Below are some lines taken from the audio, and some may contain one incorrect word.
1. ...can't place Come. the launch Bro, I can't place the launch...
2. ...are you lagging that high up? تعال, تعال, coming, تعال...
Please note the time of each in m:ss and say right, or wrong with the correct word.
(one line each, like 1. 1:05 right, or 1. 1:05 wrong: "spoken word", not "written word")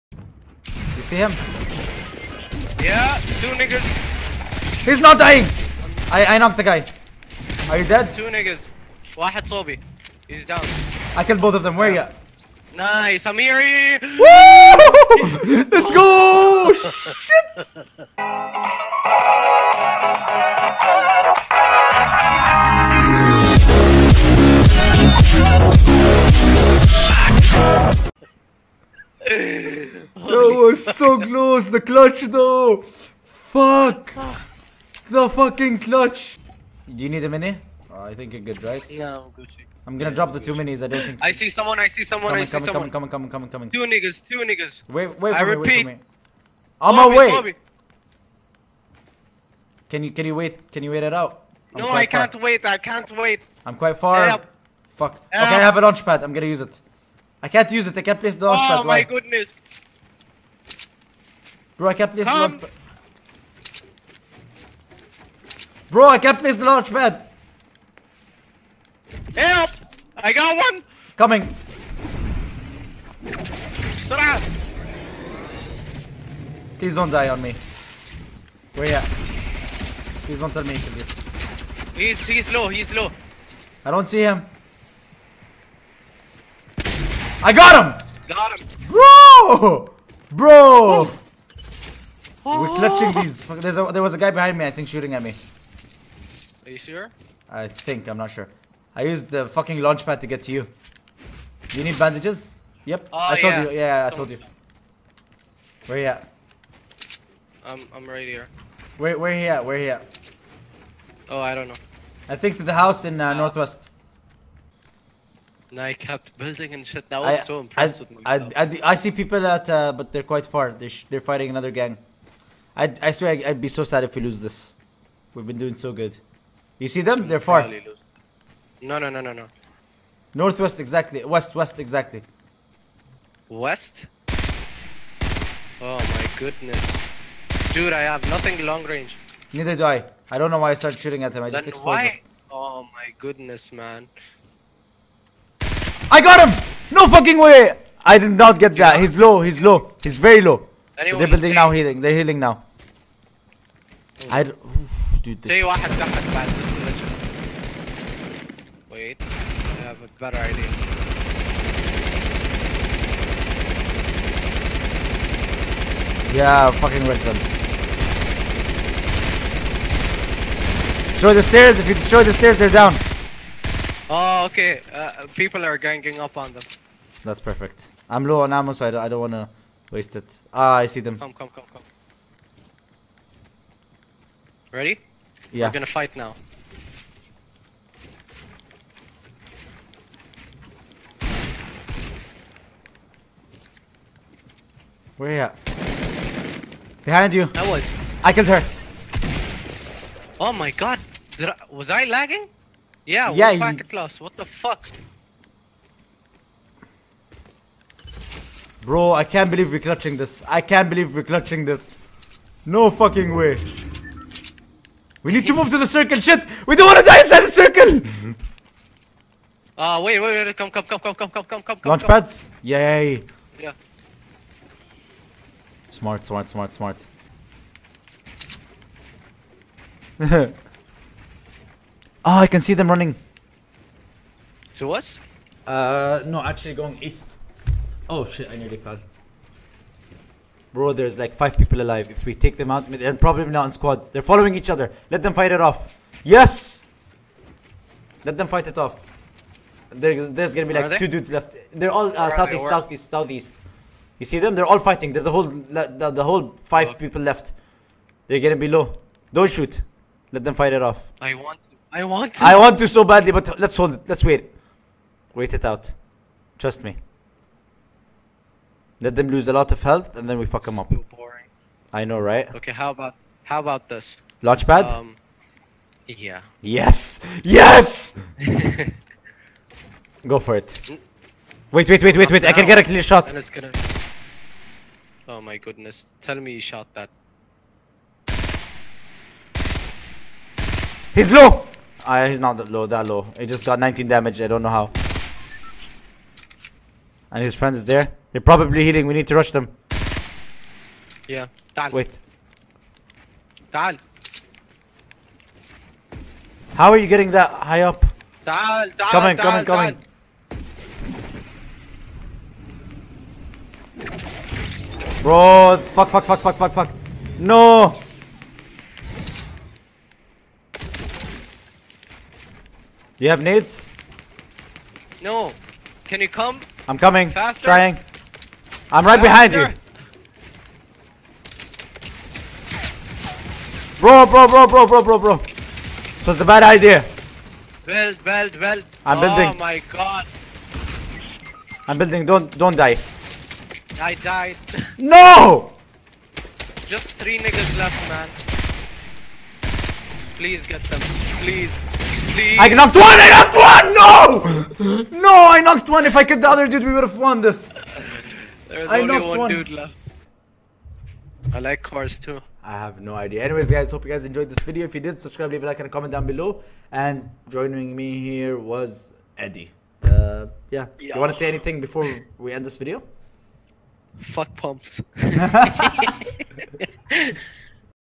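1. 1:01 right
2. 5:06 wrong: "getting", not "lagging".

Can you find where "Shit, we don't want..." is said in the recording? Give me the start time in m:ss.
3:36.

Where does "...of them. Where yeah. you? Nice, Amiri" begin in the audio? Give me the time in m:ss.
0:11.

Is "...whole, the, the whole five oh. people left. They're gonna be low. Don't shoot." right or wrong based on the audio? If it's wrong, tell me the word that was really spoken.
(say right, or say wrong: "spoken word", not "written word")
right.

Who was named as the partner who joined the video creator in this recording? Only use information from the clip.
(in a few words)
Eddie.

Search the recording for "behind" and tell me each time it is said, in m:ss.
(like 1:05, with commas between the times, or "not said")
1:34, 3:17, 5:29.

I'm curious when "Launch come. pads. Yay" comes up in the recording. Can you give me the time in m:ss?
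3:41.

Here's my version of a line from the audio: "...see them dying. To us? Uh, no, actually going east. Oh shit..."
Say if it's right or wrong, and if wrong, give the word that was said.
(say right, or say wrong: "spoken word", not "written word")
wrong: "running", not "dying".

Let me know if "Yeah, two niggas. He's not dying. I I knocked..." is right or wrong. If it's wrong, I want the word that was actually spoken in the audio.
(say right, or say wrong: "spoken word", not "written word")
right.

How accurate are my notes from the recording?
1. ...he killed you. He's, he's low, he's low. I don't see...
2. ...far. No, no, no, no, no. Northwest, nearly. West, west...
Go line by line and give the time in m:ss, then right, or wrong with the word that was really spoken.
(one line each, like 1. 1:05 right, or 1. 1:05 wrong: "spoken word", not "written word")
1. 1:20 right
2. 2:07 wrong: "exactly", not "nearly".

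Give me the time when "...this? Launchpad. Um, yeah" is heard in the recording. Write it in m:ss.
4:33.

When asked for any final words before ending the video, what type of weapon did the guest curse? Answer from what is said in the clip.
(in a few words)
pumps.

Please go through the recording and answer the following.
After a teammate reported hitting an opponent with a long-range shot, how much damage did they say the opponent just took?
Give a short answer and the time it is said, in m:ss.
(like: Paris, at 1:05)
19, at 4:53.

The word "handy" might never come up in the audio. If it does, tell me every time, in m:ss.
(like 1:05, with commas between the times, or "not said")
not said.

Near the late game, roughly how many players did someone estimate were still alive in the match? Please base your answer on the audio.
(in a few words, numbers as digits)
5.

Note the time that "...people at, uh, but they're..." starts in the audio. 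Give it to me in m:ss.
1:59.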